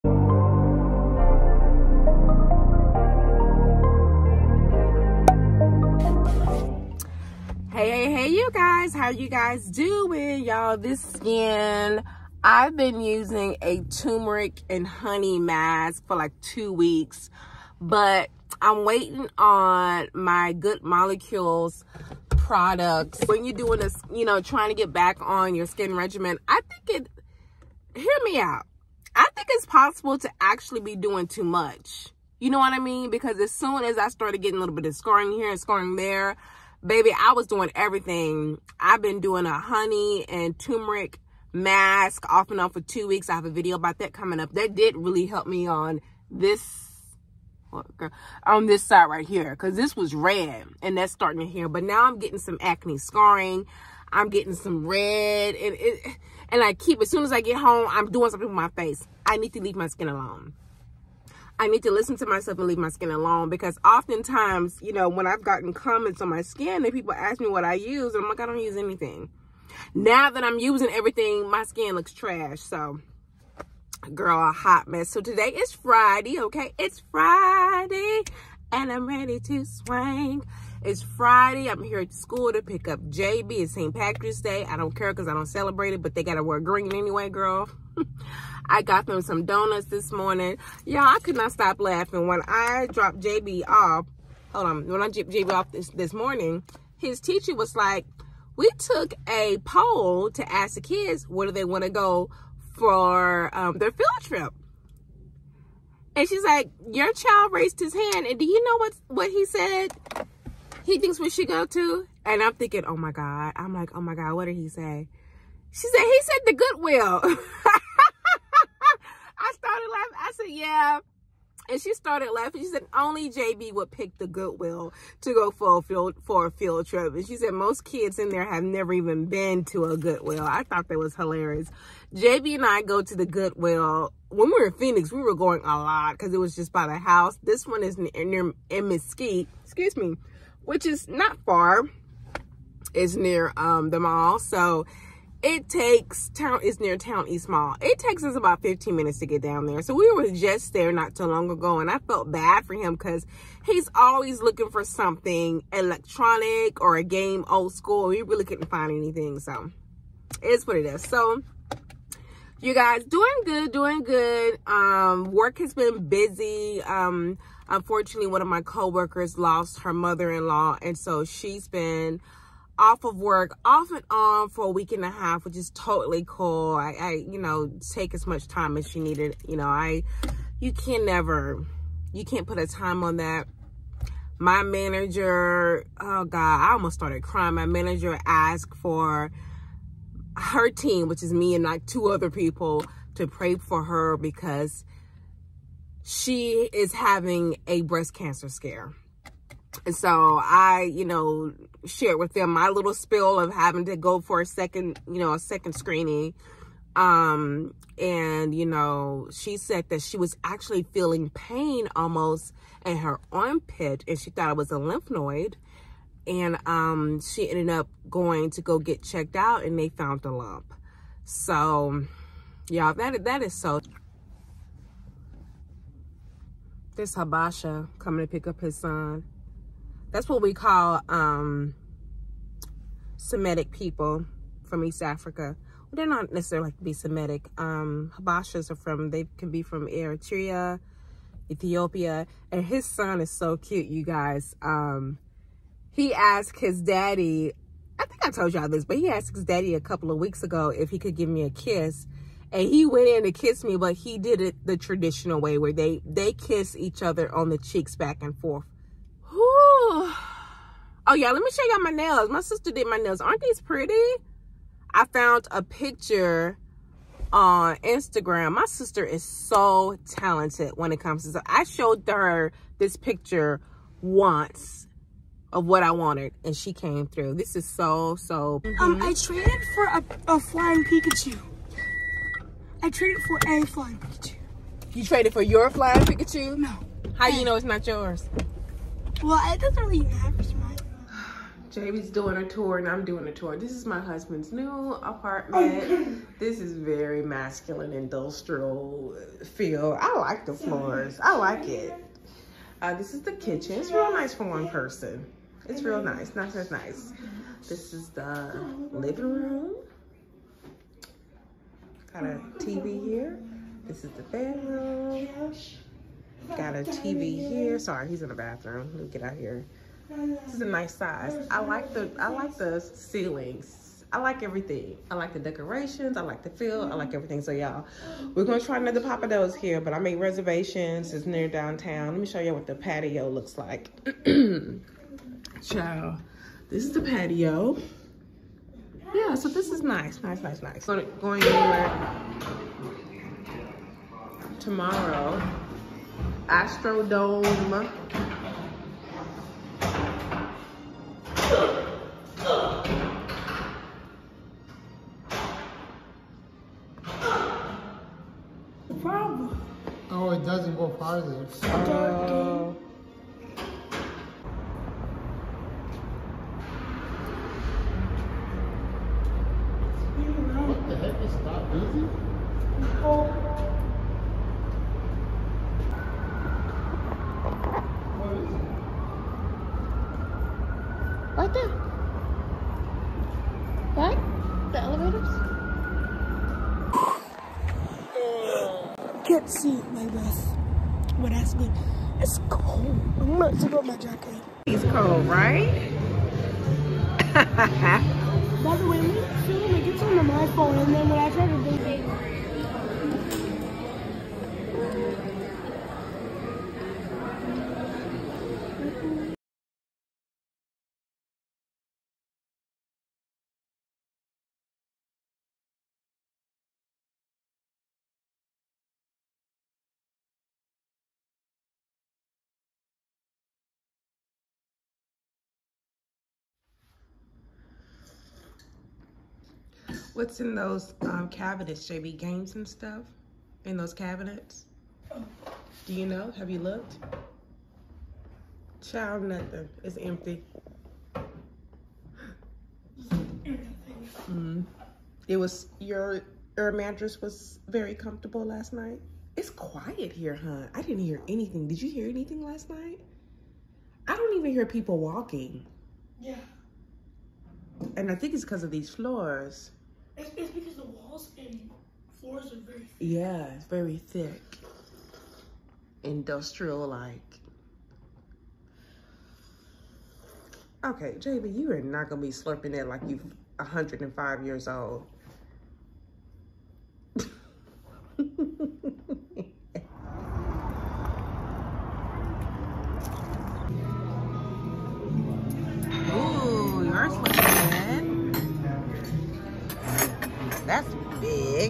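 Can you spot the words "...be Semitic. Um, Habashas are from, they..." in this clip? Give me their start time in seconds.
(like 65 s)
236 s.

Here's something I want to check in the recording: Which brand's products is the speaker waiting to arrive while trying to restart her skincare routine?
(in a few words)
Good Molecules.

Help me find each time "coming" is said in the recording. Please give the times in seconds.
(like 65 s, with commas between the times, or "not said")
44 s, 227 s.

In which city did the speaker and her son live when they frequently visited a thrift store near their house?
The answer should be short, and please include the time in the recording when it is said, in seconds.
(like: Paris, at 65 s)
Phoenix, at 134 s.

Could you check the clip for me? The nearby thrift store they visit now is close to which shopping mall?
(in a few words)
Town East Mall.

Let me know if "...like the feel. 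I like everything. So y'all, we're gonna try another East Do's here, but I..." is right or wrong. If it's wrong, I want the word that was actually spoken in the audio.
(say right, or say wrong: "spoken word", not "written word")
wrong: "Papa", not "East".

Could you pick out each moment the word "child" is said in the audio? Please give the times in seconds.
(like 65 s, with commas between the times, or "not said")
107 s, 438 s.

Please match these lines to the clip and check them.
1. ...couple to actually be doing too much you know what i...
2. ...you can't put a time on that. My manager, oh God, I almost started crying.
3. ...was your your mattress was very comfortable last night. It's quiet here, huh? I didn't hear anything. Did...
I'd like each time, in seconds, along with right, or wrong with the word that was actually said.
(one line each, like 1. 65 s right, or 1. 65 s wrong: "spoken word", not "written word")
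1. 29 s wrong: "possible", not "couple"
2. 182 s right
3. 445 s right.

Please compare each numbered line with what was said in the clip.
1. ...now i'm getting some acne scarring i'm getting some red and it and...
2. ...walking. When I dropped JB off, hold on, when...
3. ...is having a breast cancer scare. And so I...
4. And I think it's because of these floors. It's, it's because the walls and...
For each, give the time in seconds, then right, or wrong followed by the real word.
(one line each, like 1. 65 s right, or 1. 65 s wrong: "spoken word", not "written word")
1. 51 s right
2. 91 s wrong: "laughing", not "walking"
3. 196 s right
4. 457 s right.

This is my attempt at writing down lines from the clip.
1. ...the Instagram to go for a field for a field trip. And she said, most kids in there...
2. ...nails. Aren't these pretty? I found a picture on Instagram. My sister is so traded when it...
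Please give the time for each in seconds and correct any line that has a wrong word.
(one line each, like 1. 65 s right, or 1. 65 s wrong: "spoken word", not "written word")
1. 124 s wrong: "Goodwill", not "Instagram"
2. 262 s wrong: "talented", not "traded".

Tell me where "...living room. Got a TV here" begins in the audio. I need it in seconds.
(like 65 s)
308 s.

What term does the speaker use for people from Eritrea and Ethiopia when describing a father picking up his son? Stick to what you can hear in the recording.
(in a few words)
Habasha.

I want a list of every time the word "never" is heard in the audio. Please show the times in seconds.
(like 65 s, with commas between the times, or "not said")
128 s, 181 s.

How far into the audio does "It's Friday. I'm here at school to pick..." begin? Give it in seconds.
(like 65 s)
80 s.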